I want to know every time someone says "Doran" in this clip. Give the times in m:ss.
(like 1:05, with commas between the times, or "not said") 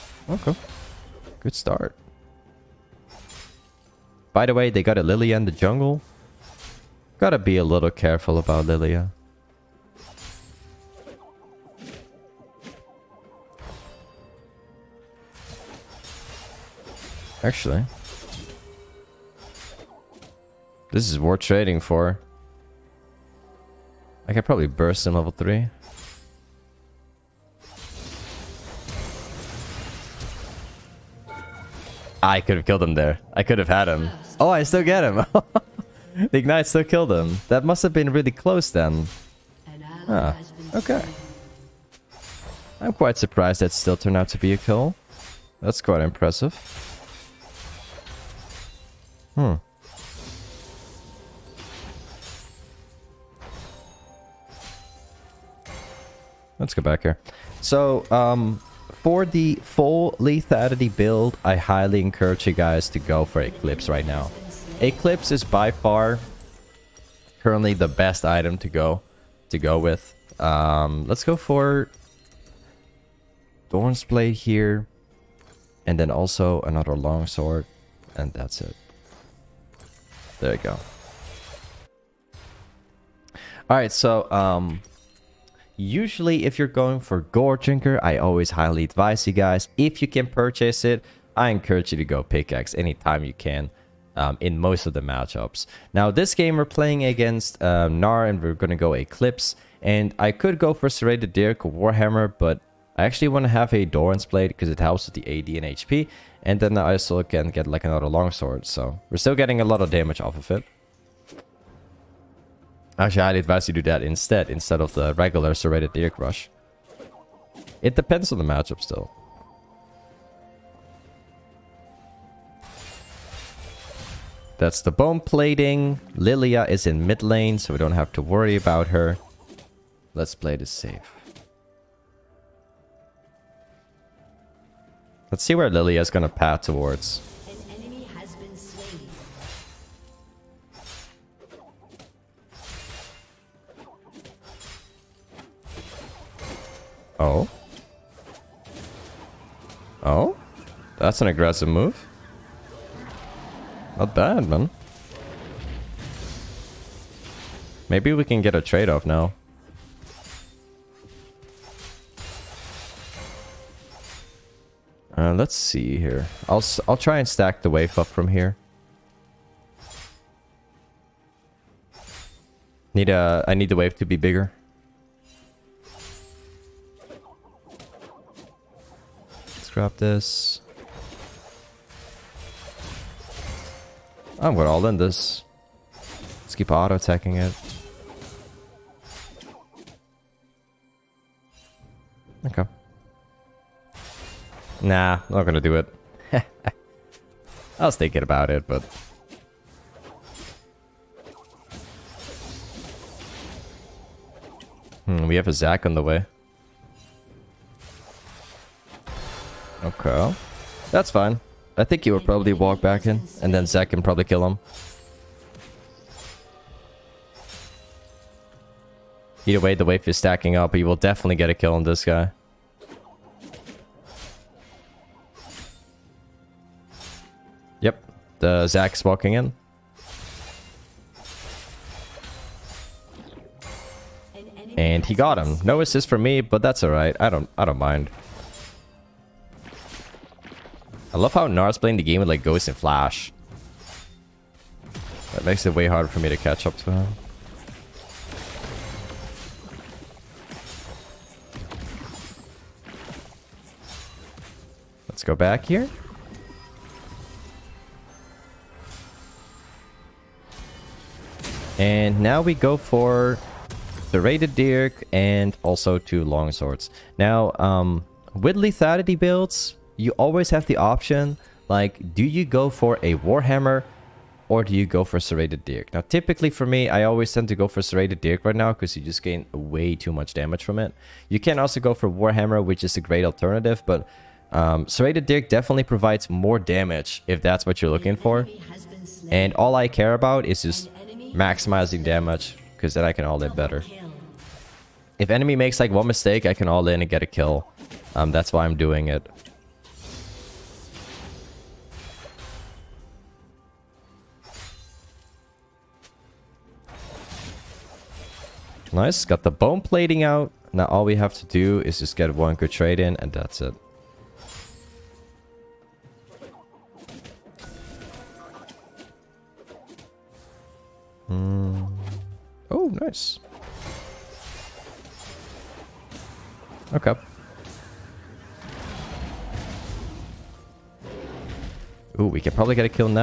1:13, 1:43.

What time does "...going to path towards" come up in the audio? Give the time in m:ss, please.
2:16.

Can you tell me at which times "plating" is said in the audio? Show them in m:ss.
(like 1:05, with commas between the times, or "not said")
2:05, 5:09.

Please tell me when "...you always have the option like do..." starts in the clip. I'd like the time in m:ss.
4:29.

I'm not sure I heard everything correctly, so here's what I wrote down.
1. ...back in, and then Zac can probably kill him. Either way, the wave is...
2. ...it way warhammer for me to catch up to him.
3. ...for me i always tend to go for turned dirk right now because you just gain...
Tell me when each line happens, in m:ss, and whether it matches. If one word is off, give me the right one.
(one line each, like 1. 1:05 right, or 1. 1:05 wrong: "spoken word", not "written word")
1. 3:32 right
2. 4:05 wrong: "harder", not "warhammer"
3. 4:36 wrong: "serrated", not "turned".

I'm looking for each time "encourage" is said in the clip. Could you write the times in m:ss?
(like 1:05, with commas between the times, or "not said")
1:02, 1:31.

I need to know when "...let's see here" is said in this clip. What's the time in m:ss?
2:45.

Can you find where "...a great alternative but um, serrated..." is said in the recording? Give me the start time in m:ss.
4:42.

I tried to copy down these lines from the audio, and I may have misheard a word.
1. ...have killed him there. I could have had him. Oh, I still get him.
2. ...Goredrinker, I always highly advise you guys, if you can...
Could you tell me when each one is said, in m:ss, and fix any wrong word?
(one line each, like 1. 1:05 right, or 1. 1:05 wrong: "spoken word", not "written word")
1. 0:32 right
2. 1:27 right.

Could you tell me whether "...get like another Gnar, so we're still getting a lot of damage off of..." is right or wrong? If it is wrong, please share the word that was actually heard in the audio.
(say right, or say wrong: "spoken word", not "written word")
wrong: "Longsword", not "Gnar".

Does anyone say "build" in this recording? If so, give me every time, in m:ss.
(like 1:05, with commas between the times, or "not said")
1:00, 4:29.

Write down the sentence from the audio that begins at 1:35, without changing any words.
Now this game we're playing against uh, Gnar and we're going to go Eclipse.